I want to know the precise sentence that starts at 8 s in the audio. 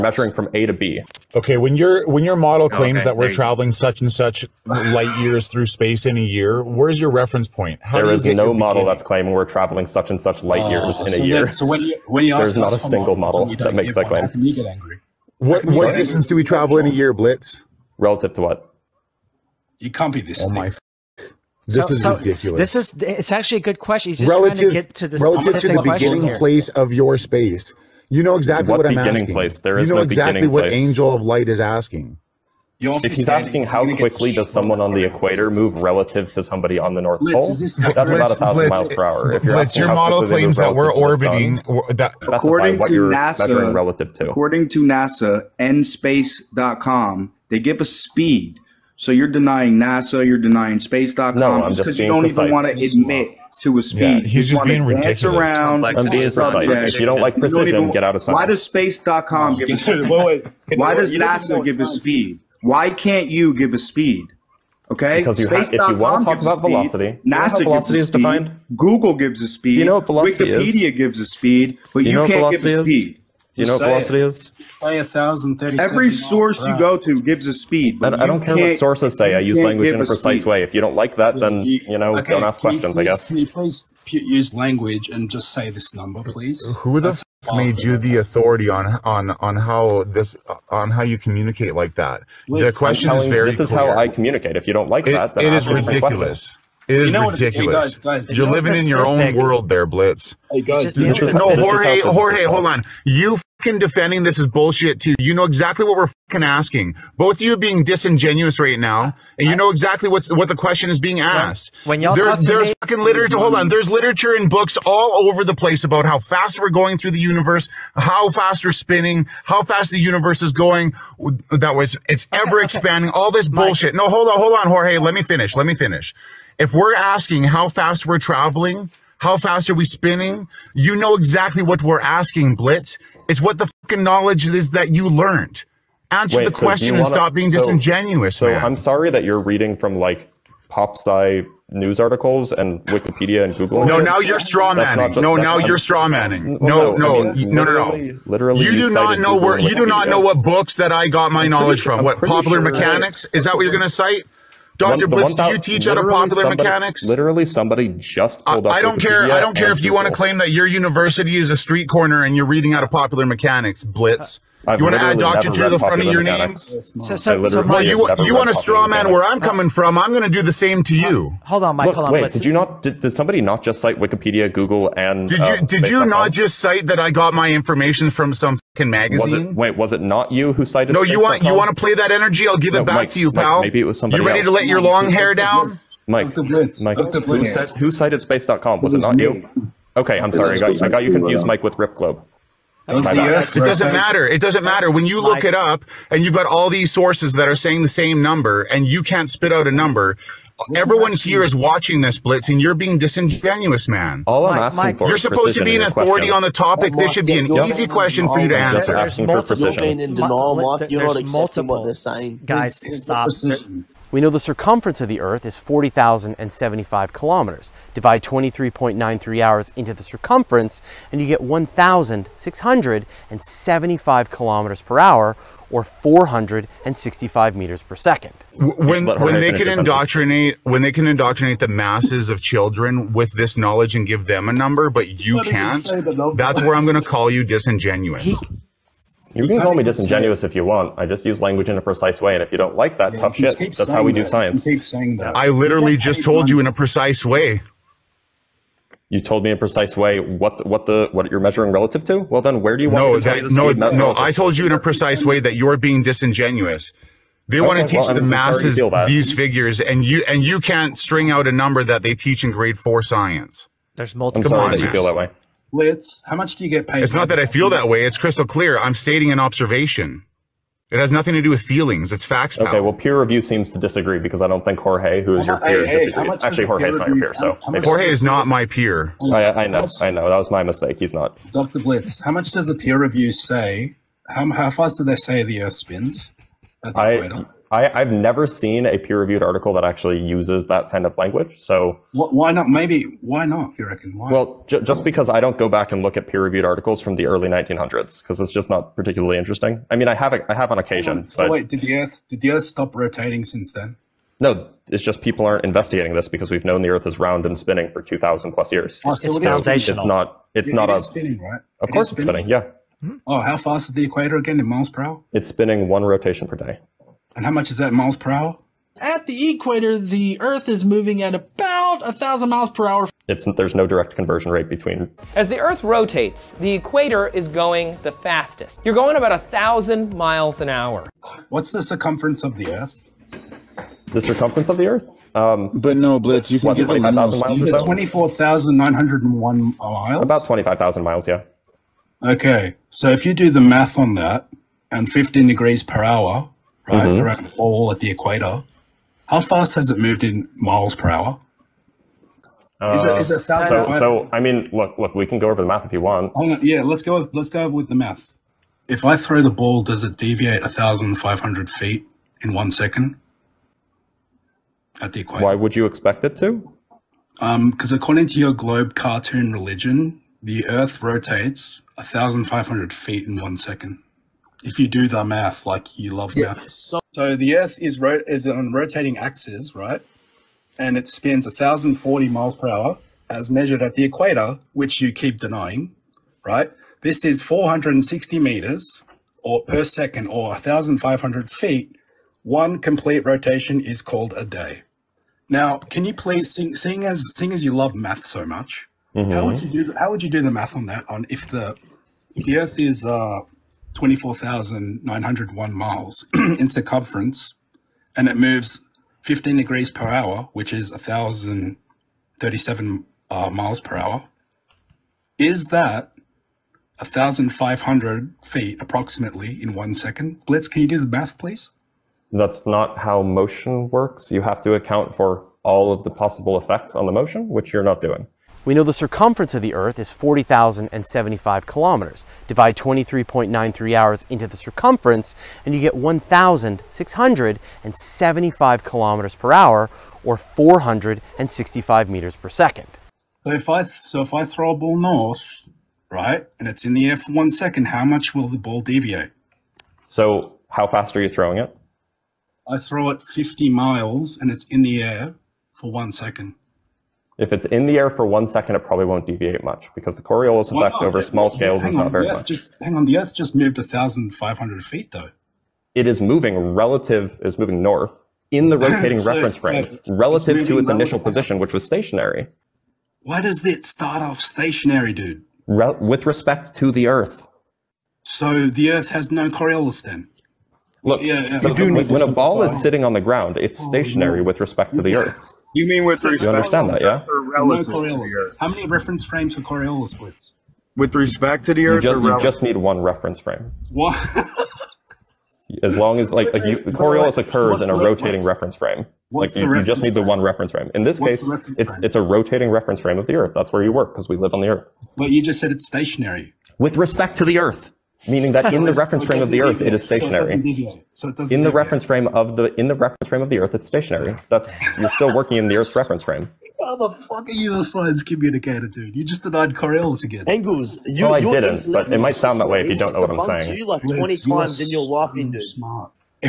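that's claiming we're traveling such and such light uh, years in so a year.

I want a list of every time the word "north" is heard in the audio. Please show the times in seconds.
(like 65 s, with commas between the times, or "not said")
37 s, 444 s, 467 s.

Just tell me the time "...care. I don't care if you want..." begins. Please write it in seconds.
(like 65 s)
158 s.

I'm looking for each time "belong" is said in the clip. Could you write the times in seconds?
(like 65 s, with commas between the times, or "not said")
not said.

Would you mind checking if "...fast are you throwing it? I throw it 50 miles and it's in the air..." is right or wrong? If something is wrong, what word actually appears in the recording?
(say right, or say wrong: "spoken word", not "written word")
right.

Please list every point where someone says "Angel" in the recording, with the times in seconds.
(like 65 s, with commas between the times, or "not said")
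30 s, 520 s.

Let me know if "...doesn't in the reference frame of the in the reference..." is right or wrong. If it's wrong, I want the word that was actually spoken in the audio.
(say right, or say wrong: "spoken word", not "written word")
right.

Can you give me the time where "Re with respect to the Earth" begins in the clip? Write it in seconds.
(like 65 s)
475 s.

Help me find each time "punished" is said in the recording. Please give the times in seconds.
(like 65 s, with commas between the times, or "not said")
not said.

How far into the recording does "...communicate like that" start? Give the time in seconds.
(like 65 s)
91 s.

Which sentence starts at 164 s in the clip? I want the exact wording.
Uh, I've you want to add doctor to the front of your name?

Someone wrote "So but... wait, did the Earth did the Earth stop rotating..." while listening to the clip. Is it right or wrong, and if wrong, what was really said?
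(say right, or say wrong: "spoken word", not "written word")
right.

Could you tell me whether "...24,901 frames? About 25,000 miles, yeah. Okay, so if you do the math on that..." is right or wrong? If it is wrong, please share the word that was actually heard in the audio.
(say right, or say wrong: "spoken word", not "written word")
wrong: "miles", not "frames".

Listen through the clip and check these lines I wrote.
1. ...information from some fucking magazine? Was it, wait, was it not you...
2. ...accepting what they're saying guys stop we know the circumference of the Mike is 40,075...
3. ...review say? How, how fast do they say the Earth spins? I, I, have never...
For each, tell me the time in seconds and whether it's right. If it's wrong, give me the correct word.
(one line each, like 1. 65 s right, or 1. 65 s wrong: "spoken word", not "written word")
1. 177 s right
2. 209 s wrong: "Earth", not "Mike"
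3. 282 s right.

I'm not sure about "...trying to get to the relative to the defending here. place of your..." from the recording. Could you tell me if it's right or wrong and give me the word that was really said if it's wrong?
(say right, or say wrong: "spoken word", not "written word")
wrong: "beginning", not "defending".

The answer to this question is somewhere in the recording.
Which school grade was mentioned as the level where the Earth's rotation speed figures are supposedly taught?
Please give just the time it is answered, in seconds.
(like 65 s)
262 s.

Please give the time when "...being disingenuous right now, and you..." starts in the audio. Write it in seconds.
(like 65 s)
107 s.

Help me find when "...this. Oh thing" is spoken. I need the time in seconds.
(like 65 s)
20 s.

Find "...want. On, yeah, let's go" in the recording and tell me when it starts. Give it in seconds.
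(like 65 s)
356 s.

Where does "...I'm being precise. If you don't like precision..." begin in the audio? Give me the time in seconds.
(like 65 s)
55 s.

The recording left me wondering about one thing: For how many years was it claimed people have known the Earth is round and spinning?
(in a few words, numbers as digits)
2,000 plus years.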